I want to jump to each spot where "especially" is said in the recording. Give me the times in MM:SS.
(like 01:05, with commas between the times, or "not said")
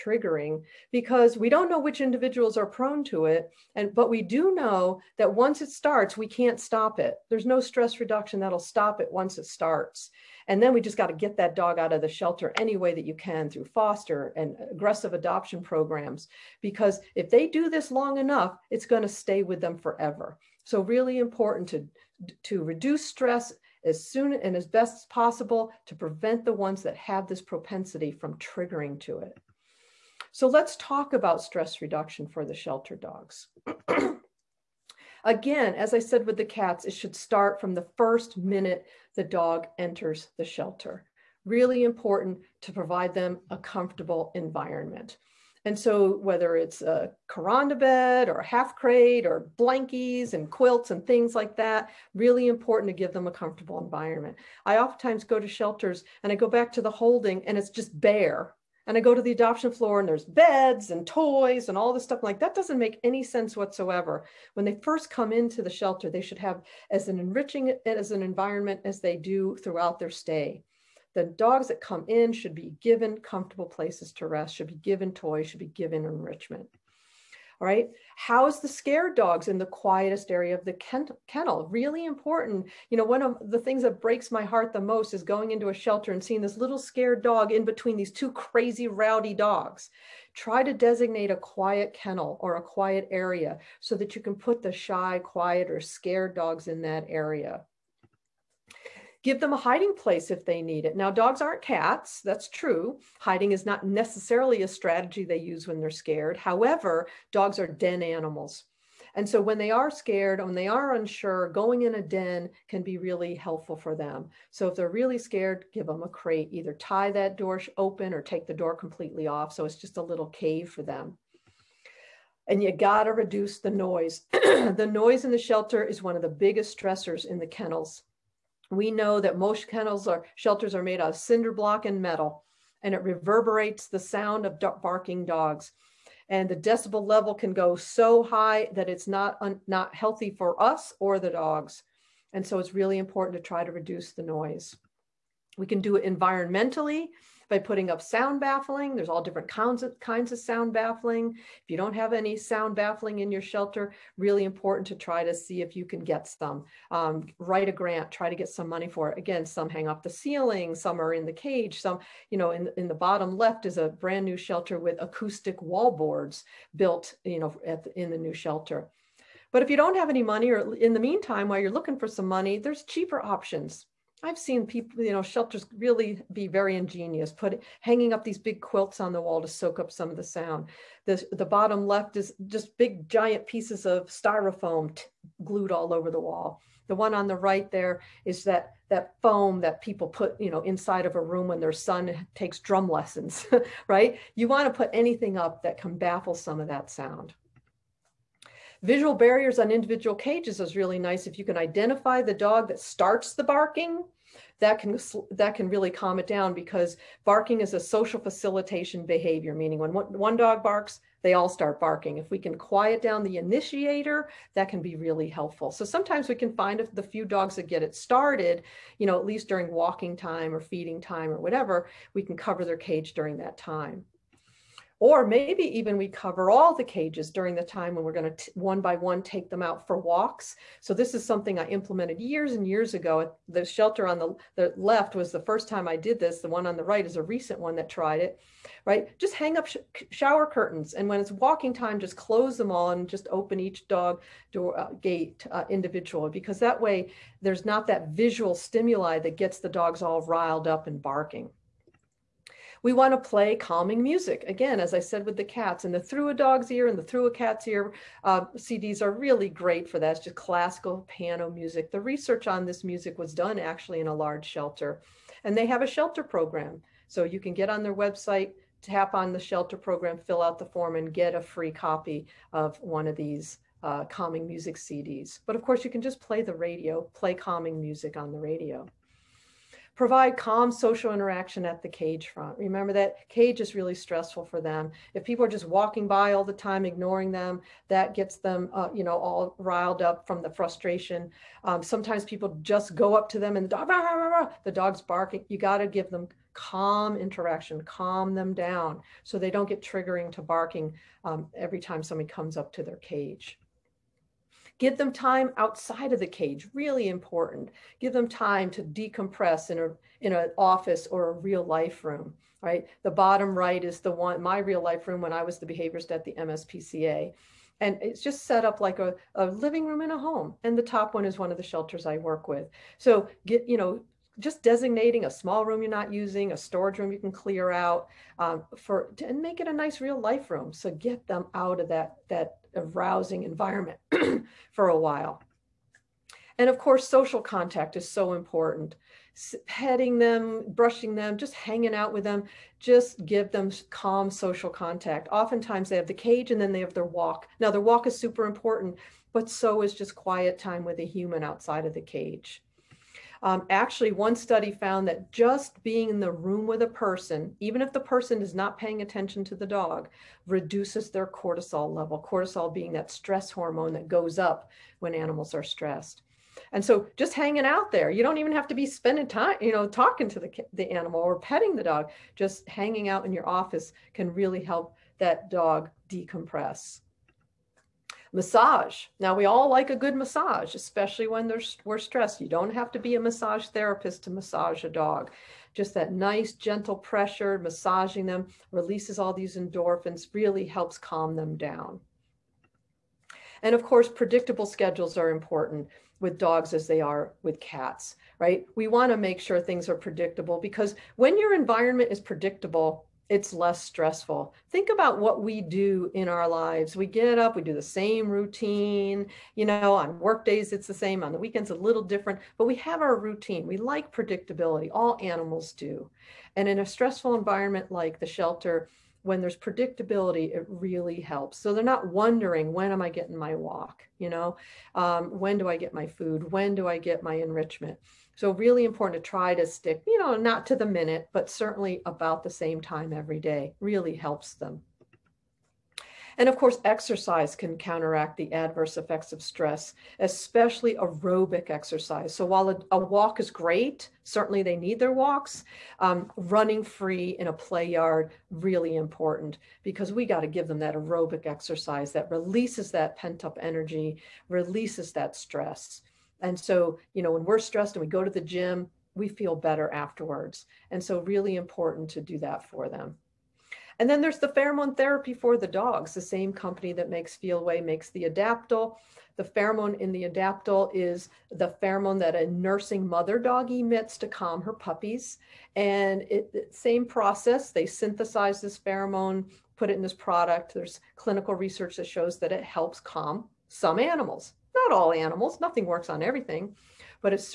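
06:20, 07:20.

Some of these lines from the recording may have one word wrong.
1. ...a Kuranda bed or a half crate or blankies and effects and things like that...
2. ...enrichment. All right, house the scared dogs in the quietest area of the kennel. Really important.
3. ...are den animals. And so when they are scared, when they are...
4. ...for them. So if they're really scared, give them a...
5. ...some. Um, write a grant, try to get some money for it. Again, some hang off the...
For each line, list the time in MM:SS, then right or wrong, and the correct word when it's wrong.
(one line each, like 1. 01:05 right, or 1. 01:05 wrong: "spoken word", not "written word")
1. 00:46 wrong: "quilts", not "effects"
2. 01:16 right
3. 01:47 right
4. 01:53 right
5. 02:36 right.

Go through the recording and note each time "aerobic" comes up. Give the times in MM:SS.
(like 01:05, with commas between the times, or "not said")
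07:20, 07:30.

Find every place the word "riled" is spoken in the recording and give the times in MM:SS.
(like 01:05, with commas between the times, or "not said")
04:10, 04:49.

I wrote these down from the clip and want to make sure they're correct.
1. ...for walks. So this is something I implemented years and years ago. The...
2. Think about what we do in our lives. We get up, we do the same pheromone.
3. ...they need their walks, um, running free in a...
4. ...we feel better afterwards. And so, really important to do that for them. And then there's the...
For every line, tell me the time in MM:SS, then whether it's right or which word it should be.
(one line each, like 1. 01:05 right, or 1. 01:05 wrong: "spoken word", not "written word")
1. 03:49 right
2. 06:44 wrong: "routine", not "pheromone"
3. 07:24 right
4. 07:39 right.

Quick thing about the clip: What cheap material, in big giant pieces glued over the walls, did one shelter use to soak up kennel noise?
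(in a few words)
styrofoam.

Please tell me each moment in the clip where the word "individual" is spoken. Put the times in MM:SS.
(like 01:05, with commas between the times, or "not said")
00:02, 03:19, 04:05.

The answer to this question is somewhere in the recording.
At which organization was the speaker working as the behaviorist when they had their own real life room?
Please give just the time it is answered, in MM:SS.
05:16.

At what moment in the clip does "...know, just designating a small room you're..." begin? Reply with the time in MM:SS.
05:23.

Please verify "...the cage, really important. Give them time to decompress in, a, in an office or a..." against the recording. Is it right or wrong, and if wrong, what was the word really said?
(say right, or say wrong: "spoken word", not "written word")
right.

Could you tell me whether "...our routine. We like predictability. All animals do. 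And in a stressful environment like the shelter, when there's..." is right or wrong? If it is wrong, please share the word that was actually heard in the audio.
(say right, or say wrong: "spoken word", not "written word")
right.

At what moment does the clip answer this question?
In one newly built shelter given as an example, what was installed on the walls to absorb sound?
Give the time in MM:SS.
02:45.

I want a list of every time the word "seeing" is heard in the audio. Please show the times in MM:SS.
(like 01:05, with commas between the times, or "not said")
01:26.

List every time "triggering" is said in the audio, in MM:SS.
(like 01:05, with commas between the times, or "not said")
00:28, 04:59.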